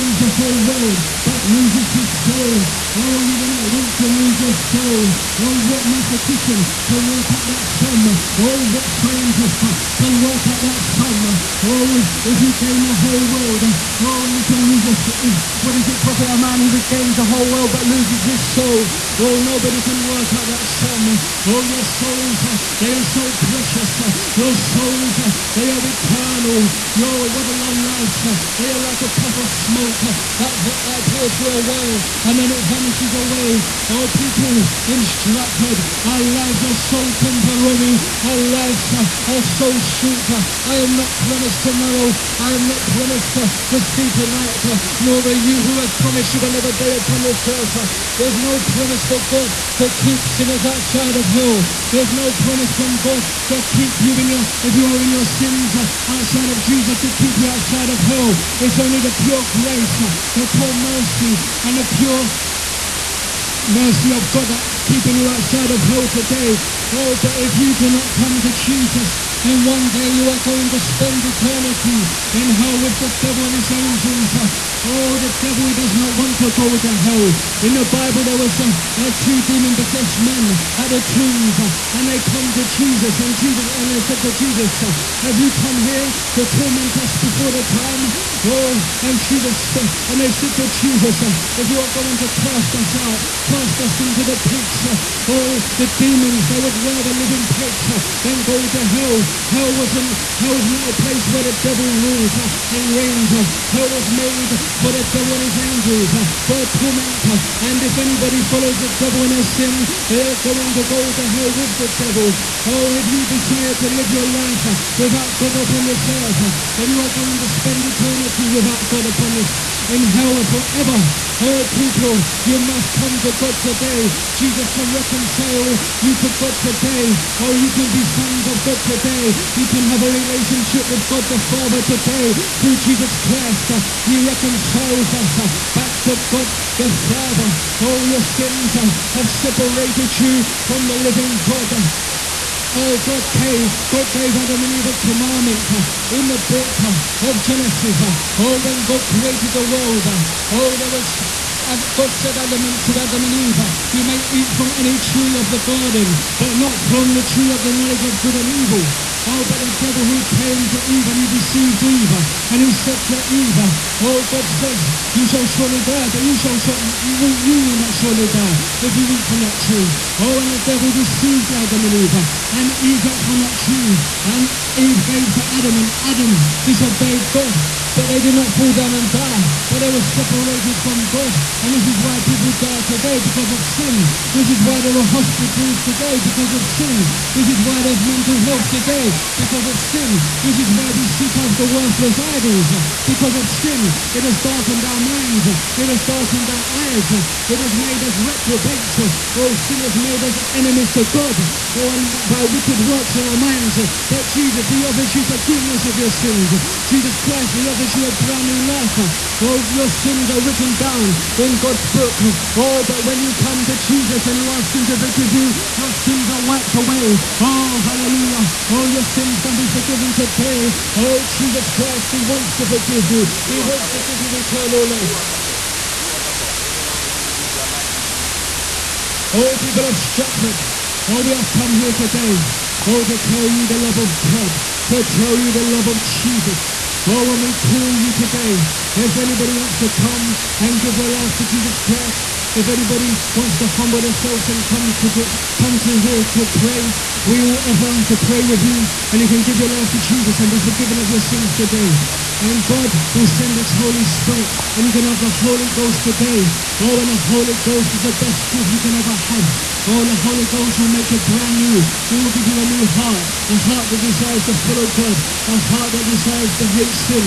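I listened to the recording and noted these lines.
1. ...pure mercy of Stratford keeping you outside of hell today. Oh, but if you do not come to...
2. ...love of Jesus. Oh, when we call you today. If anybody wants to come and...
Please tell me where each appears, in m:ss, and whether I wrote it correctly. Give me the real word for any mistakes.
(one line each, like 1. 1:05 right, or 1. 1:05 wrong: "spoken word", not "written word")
1. 1:01 wrong: "God", not "Stratford"
2. 3:55 right.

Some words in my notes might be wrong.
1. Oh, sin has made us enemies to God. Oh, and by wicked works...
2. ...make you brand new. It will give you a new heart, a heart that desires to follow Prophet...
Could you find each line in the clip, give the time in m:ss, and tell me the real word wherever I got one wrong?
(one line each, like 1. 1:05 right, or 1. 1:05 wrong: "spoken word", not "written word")
1. 3:19 right
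2. 4:20 wrong: "God", not "Prophet".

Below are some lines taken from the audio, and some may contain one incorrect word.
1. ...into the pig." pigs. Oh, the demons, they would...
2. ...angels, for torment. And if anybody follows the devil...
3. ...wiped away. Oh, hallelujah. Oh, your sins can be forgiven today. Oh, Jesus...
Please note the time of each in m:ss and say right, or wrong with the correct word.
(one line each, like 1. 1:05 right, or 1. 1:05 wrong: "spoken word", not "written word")
1. 1:33 right
2. 1:45 right
3. 3:36 right.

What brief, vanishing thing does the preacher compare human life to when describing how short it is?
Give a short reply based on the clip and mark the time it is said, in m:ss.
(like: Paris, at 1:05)
A puff of smoke, at 0:29.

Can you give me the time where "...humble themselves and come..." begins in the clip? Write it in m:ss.
4:03.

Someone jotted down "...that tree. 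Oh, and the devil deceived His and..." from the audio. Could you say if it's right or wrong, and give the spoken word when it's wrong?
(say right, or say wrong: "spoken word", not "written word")
wrong: "Adam", not "His".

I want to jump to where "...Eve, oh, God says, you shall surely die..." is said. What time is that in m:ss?
2:43.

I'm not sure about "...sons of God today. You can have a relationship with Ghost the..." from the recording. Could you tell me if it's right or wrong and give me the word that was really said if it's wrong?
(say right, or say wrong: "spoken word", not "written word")
wrong: "God", not "Ghost".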